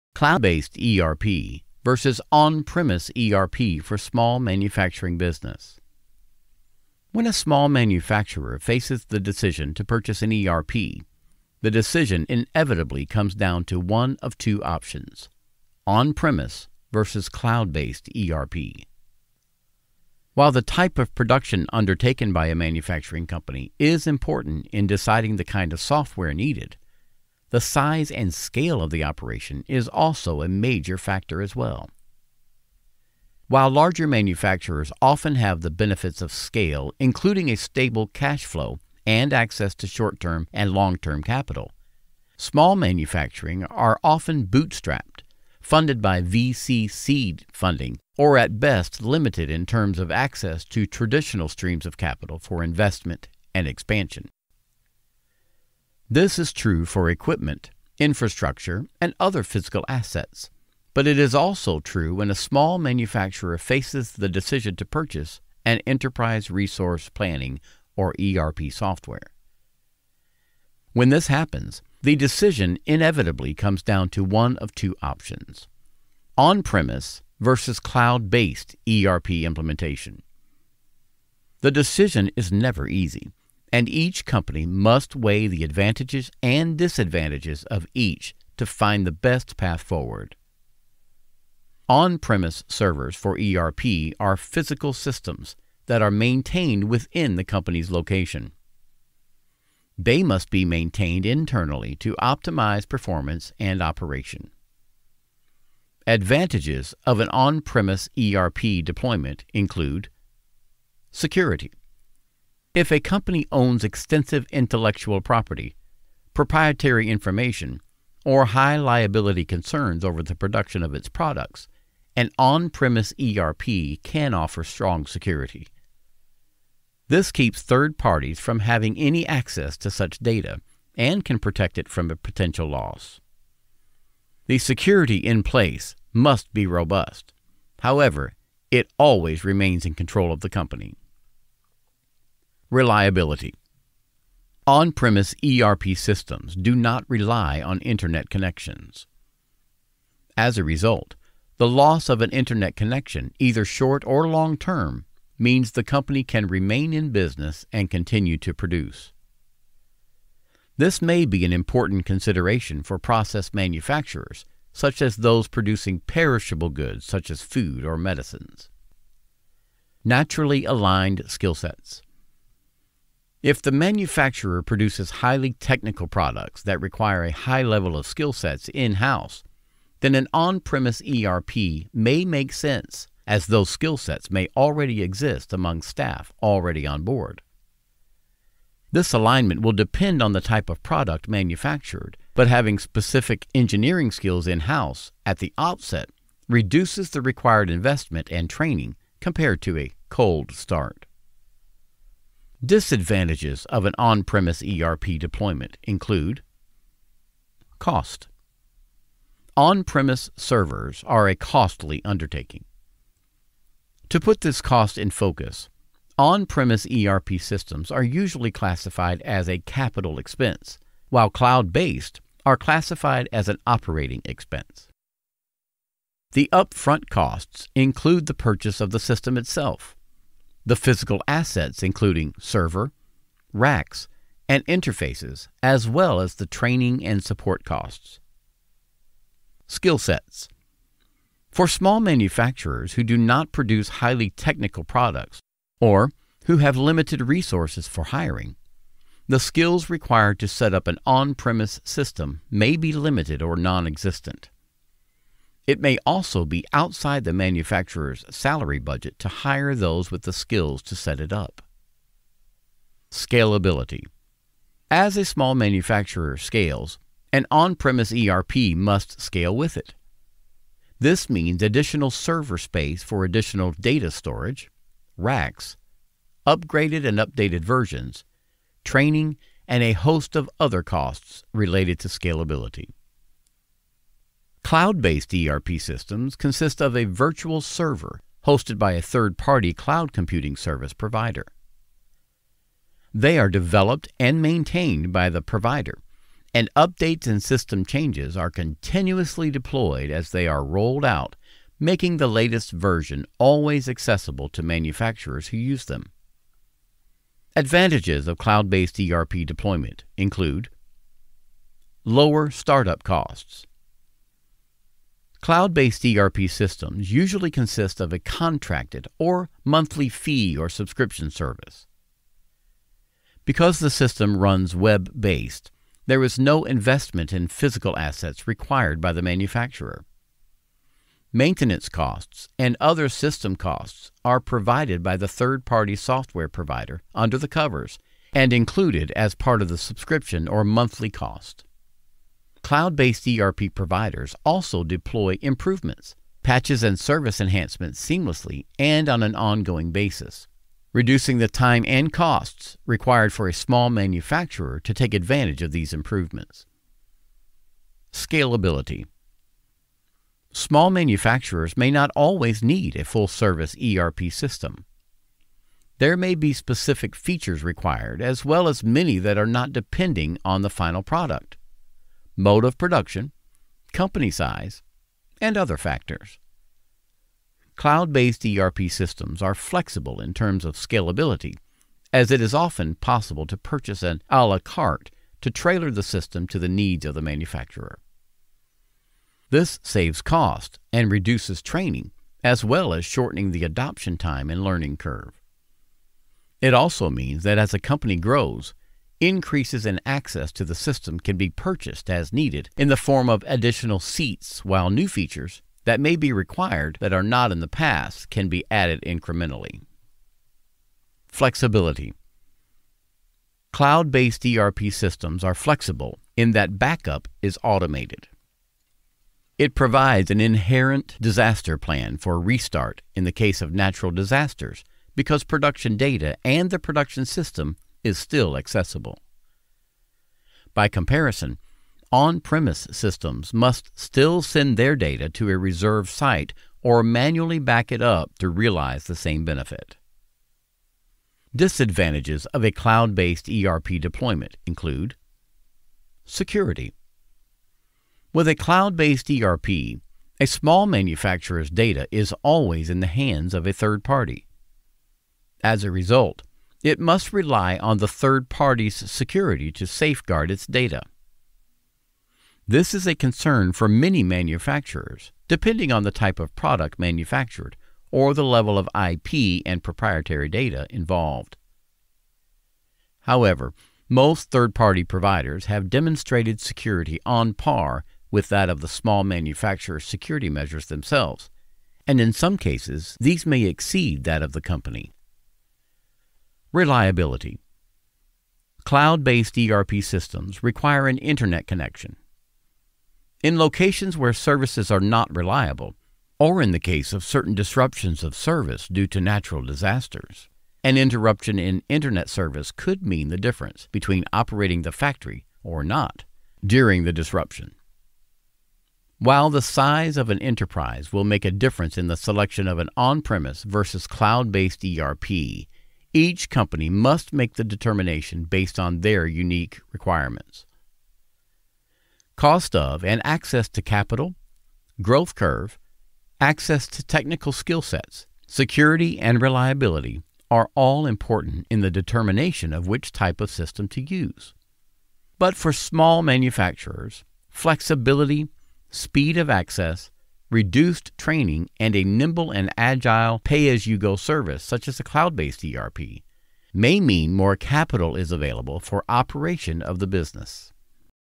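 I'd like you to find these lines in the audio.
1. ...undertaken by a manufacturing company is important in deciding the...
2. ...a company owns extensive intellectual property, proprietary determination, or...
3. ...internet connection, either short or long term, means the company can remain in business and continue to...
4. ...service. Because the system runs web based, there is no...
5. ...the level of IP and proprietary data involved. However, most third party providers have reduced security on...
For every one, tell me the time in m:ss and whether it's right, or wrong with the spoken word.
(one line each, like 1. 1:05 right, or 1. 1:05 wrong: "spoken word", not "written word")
1. 0:21 right
2. 1:52 wrong: "information", not "determination"
3. 2:32 right
4. 5:21 right
5. 7:48 wrong: "demonstrated", not "reduced".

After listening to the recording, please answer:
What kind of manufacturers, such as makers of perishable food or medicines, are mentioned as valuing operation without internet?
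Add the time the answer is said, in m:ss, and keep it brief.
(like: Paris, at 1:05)
Process manufacturers, at 2:42.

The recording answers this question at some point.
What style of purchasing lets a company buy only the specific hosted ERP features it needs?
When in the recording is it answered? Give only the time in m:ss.
6:24.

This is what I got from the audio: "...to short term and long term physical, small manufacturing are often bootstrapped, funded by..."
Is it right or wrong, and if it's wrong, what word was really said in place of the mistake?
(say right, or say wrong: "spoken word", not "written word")
wrong: "capital", not "physical".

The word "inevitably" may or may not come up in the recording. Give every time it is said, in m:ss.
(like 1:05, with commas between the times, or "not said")
0:12, 1:12.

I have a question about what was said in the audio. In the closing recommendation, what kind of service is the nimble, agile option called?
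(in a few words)
Pay as you go.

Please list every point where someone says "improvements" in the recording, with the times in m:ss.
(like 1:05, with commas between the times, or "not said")
5:45, 5:55.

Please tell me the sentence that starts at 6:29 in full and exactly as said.
This saves cost and reduces training, as well as shortening the adoption time and learning curve.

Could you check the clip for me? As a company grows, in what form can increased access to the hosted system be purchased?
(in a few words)
Additional seats.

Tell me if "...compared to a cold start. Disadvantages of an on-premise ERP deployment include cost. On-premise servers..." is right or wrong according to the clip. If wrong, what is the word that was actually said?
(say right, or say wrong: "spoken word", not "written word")
right.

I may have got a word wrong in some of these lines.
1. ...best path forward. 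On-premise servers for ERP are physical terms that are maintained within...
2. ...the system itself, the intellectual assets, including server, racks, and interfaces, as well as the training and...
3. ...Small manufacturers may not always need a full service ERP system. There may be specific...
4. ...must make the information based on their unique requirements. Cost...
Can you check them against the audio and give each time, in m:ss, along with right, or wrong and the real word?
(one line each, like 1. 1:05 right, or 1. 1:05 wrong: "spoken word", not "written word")
1. 1:29 wrong: "systems", not "terms"
2. 3:48 wrong: "physical", not "intellectual"
3. 6:00 right
4. 8:36 wrong: "determination", not "information".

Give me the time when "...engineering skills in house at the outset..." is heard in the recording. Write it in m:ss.
3:13.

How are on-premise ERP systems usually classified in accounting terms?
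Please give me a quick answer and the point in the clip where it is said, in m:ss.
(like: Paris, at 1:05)
Capital expense, at 3:39.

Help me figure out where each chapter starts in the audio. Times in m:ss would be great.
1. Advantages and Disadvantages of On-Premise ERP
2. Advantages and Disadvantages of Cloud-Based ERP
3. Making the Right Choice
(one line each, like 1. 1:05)
1. 1:51
2. 5:08
3. 8:29.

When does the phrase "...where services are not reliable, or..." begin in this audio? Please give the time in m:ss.
8:14.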